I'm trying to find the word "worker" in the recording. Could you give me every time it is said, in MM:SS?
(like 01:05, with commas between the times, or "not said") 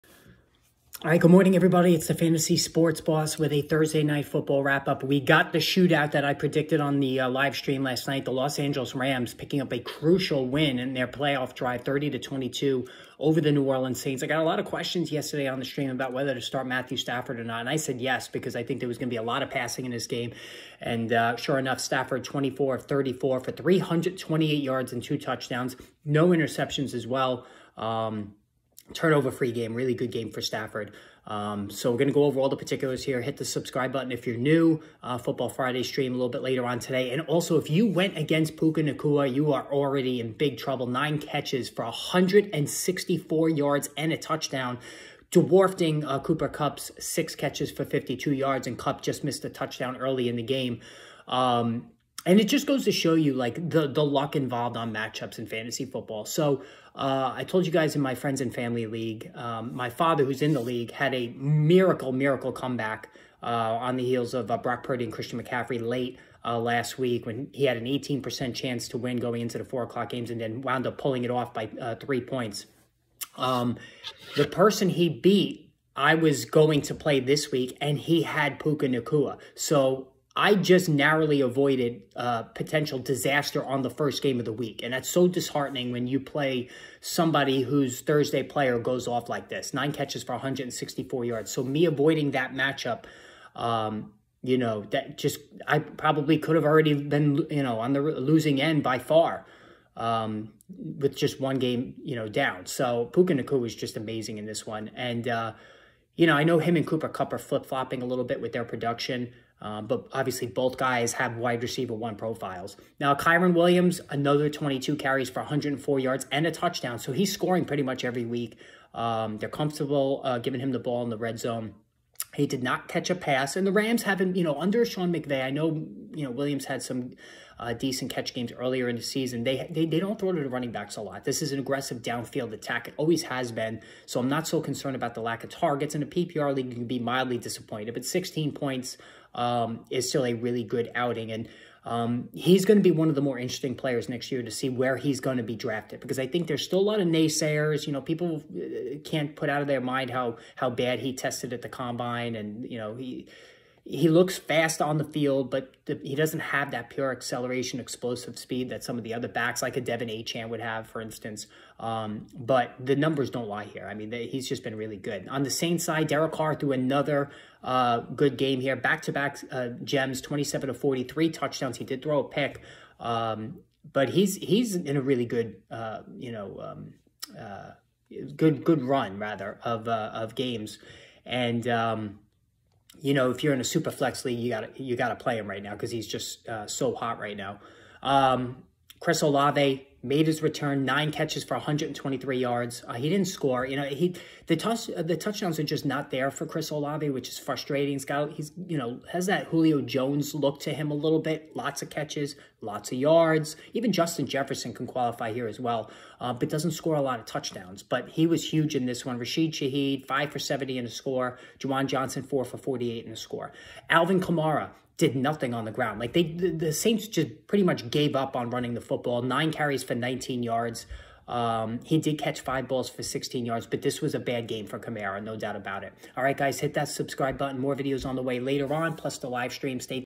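not said.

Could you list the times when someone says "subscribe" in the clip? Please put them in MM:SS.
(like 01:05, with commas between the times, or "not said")
00:33, 03:46.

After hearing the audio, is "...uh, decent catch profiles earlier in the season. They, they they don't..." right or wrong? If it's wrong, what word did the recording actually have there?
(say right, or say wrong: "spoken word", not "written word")
wrong: "games", not "profiles".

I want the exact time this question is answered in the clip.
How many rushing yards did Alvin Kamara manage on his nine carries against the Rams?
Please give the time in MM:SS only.
03:39.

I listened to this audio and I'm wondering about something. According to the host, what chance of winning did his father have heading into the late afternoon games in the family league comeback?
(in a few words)
18%.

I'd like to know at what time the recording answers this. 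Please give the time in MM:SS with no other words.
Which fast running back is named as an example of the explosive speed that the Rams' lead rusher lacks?
02:39.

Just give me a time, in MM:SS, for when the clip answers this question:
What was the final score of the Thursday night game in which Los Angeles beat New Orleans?
00:11.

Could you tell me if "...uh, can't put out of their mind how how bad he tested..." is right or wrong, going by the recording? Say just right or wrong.
right.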